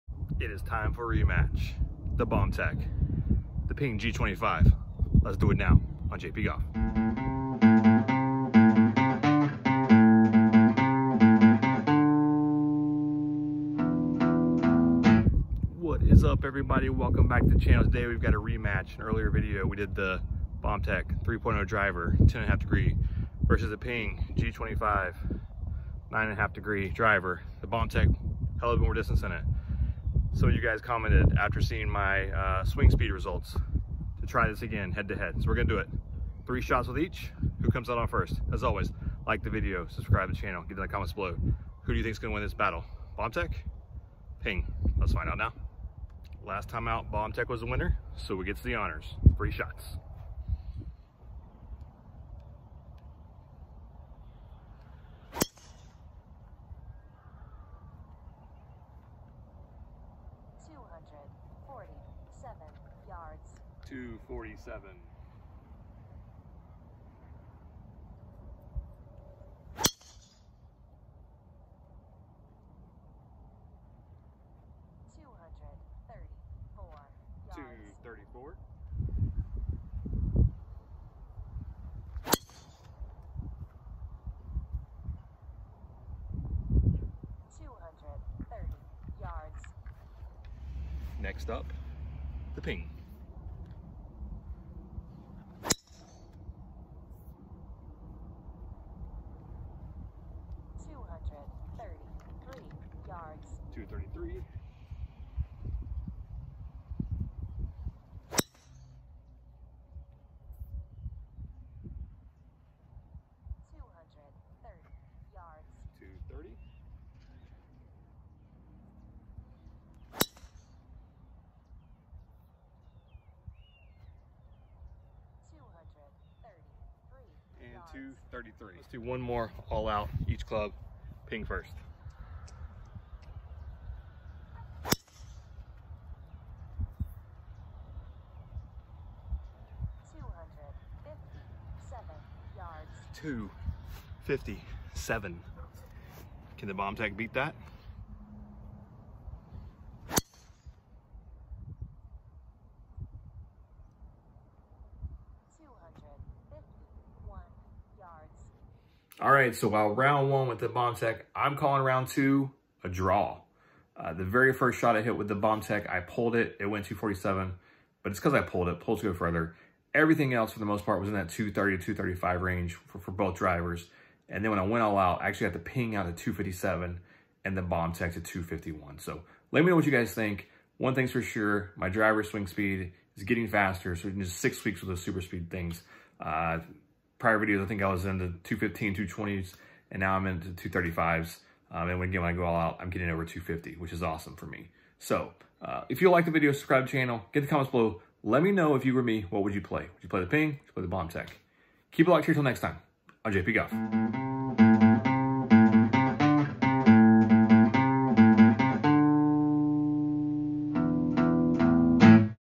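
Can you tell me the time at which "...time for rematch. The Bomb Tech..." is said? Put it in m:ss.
0:00.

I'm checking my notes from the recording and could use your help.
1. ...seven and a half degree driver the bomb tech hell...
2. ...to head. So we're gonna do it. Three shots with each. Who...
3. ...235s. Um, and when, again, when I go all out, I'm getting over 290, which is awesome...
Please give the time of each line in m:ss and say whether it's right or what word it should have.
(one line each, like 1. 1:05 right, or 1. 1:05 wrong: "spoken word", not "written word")
1. 0:26 wrong: "nine", not "seven"
2. 0:35 right
3. 3:10 wrong: "250", not "290".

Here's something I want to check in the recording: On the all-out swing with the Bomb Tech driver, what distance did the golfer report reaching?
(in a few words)
251.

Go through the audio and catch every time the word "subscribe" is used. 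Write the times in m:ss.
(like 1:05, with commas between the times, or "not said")
0:39, 3:16.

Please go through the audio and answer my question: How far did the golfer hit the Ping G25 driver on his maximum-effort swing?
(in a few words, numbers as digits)
257 yards.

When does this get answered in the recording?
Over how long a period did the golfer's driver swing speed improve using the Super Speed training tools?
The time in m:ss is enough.
3:04.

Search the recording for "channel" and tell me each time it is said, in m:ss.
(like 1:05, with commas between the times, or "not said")
0:17, 0:40, 3:16.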